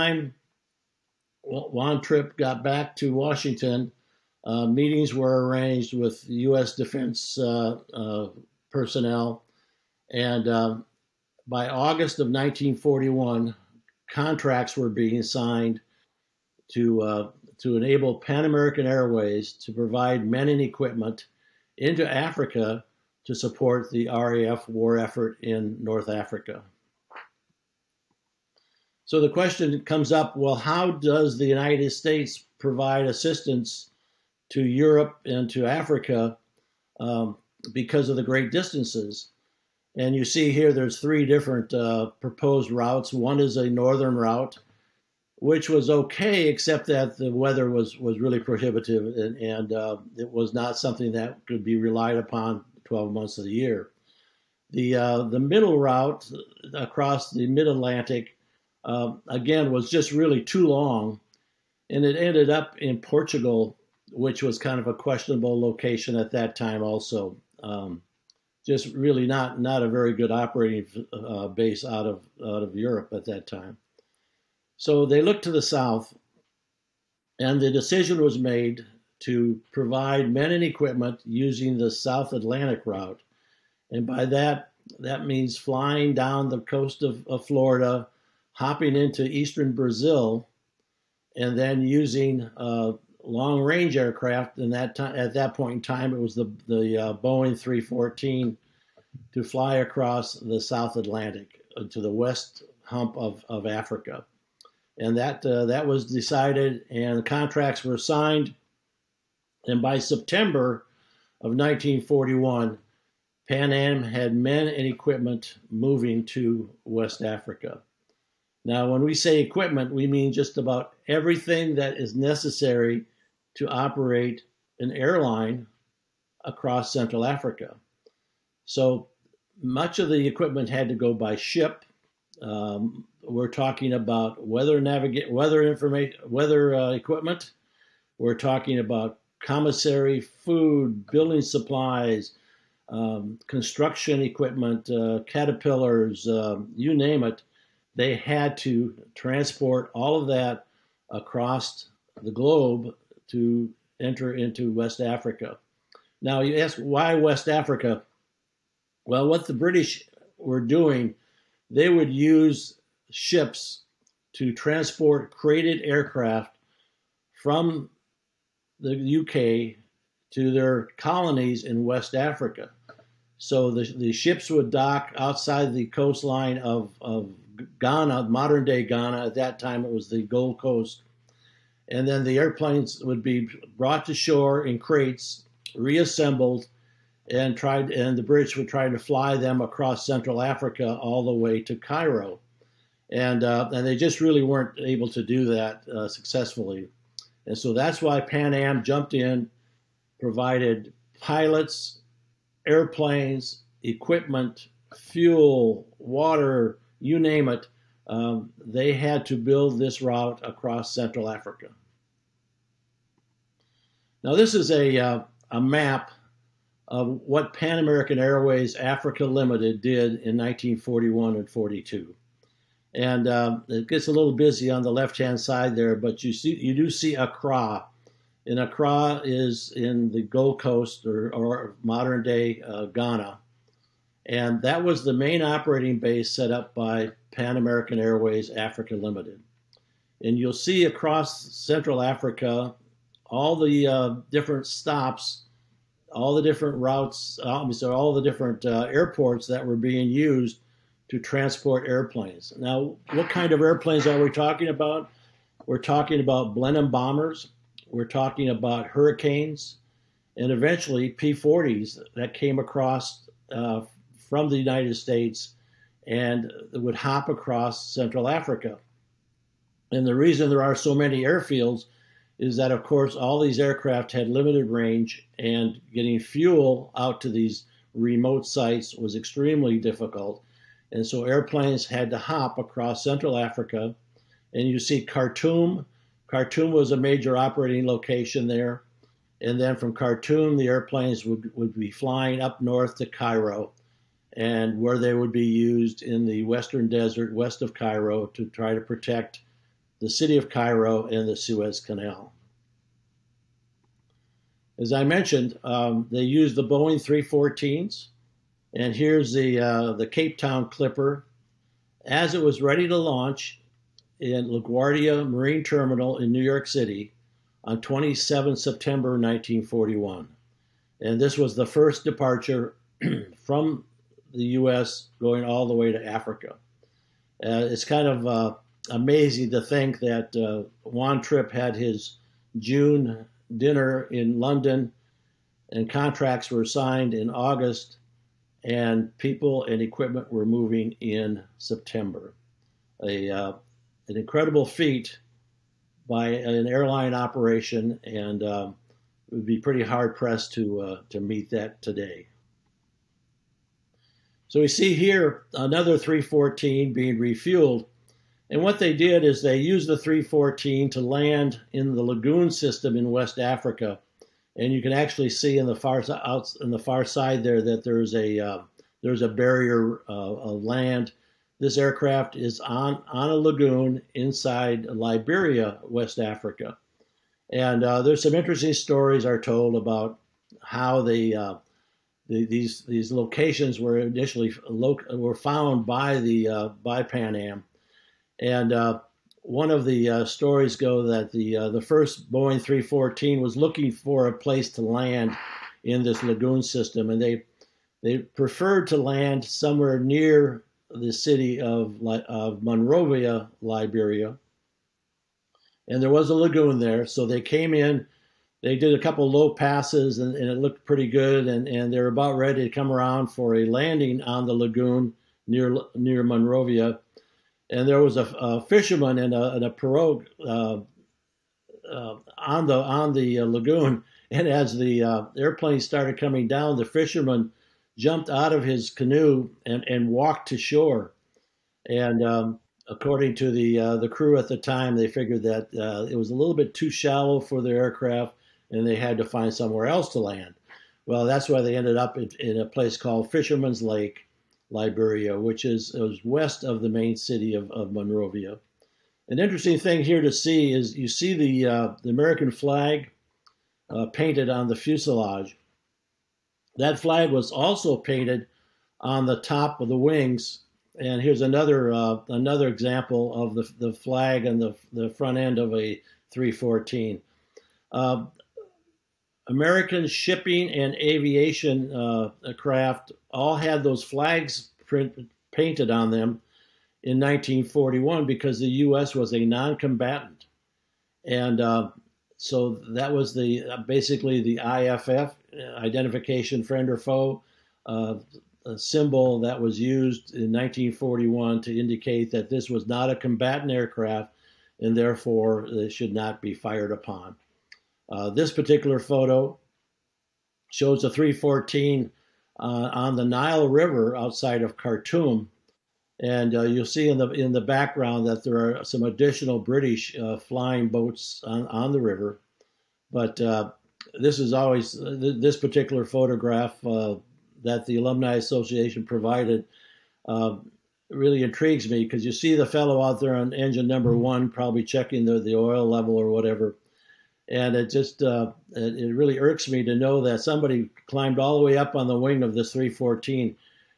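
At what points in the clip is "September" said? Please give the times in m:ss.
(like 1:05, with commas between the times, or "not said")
1:49, 5:18, 5:41.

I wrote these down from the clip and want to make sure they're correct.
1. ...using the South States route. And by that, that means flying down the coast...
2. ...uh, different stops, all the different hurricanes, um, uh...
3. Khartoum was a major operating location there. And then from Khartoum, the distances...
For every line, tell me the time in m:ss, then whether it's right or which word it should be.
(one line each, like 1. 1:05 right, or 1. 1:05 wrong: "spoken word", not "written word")
1. 1:21 wrong: "Atlantic", not "States"
2. 4:03 wrong: "routes", not "hurricanes"
3. 4:46 wrong: "airplanes", not "distances".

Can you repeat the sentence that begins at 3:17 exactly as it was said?
And so that's why Pan Am jumped in, provided pilots, airplanes, equipment, fuel, water, you name it.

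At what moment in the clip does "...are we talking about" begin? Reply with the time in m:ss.
4:14.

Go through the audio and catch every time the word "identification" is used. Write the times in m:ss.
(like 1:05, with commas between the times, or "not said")
8:05.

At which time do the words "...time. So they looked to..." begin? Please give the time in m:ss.
1:13.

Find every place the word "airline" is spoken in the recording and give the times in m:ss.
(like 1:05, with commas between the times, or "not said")
2:04, 5:46.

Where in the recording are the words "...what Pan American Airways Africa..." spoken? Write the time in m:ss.
3:37.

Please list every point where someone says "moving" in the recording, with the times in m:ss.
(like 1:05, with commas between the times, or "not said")
1:55, 5:40.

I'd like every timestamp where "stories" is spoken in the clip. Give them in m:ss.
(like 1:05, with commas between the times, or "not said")
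6:18, 6:30.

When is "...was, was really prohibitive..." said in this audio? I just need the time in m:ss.
0:47.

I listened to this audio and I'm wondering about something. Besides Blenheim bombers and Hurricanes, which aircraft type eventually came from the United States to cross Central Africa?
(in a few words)
P-40s.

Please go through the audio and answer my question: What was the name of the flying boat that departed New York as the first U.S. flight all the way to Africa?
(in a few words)
Cape Town Clipper.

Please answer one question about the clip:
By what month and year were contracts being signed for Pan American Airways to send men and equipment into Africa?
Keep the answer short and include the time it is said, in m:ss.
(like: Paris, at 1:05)
August 1941, at 0:11.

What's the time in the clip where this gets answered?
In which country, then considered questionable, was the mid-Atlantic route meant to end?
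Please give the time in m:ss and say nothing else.
1:03.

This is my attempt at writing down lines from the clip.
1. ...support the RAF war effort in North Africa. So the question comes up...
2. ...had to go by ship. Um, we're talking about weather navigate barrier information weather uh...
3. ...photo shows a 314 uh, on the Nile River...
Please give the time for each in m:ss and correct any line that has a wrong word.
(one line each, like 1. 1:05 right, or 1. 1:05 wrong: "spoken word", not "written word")
1. 0:23 right
2. 2:10 wrong: "weather", not "barrier"
3. 8:18 right.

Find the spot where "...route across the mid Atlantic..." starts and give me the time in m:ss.
0:55.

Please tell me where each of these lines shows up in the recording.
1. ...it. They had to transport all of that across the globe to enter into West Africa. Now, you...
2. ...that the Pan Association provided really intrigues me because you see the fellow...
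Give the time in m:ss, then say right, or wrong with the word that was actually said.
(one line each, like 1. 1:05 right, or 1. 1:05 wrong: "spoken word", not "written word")
1. 2:27 right
2. 8:37 wrong: "Alumni", not "Pan".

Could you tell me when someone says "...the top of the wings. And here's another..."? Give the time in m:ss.
7:39.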